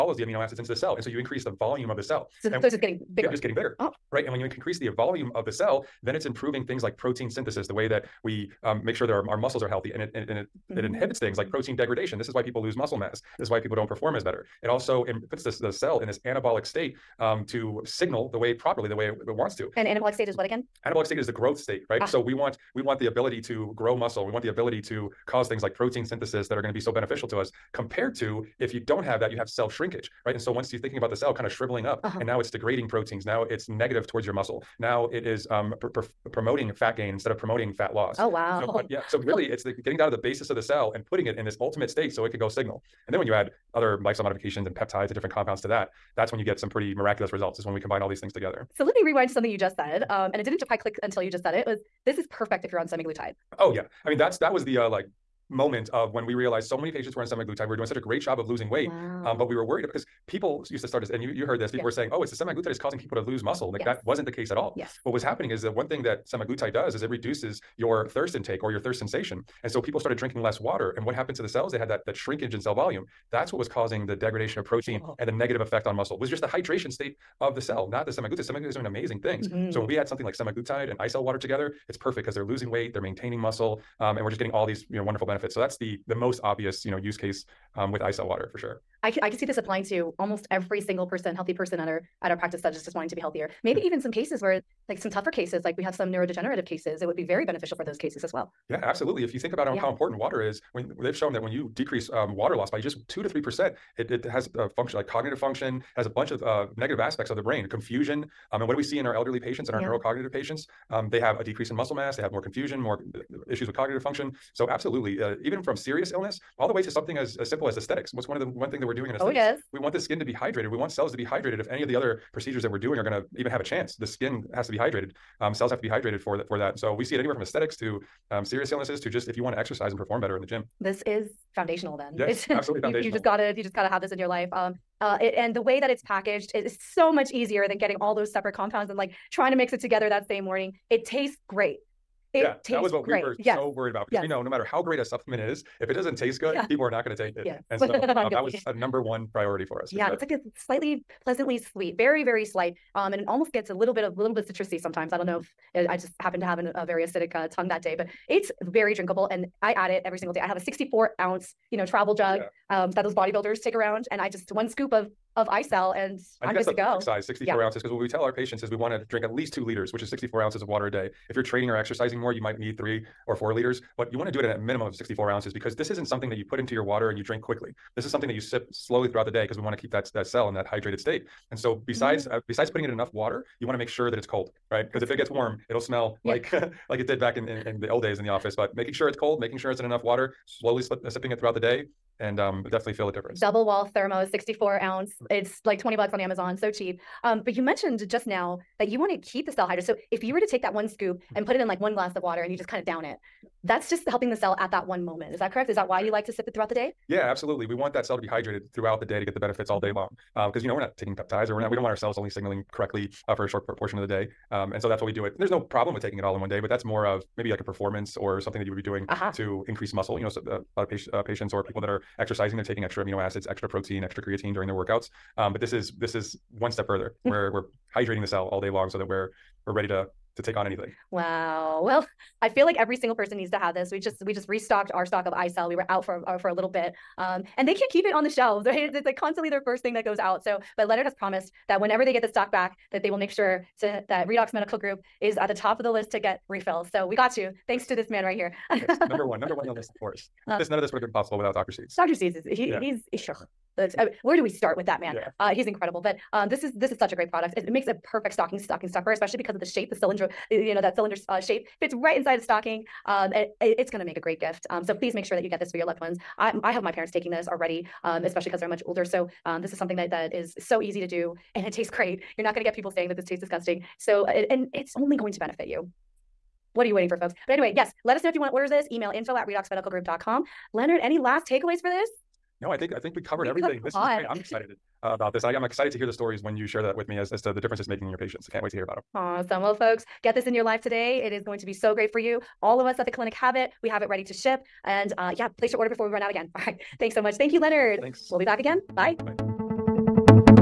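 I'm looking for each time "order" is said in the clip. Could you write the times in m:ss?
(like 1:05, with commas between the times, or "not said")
4:38, 4:55.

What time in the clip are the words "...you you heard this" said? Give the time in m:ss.
1:01.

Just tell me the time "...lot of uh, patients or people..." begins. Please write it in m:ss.
3:40.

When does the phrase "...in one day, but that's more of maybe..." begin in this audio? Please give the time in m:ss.
3:36.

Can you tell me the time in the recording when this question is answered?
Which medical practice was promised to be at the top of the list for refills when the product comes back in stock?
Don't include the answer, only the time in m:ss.
4:04.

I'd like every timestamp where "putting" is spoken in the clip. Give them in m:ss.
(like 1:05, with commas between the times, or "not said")
0:41, 3:02.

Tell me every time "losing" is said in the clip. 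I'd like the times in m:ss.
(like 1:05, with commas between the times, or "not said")
0:58, 1:22.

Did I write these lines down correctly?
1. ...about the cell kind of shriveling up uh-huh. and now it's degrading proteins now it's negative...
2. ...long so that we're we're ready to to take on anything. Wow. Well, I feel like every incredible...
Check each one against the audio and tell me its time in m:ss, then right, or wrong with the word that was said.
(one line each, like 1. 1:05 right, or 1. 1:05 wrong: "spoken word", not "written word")
1. 0:30 right
2. 3:48 wrong: "single", not "incredible".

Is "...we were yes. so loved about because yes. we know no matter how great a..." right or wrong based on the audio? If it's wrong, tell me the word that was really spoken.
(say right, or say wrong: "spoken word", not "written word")
wrong: "worried", not "loved".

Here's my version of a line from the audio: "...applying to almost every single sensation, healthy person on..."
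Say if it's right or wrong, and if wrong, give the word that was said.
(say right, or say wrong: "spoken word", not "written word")
wrong: "person", not "sensation".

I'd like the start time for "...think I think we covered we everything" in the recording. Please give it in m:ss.
4:42.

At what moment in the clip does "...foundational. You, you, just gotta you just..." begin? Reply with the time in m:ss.
2:12.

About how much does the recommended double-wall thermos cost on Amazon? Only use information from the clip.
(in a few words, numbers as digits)
20 bucks.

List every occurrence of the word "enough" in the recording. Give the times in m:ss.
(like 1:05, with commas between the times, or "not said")
3:02, 3:09.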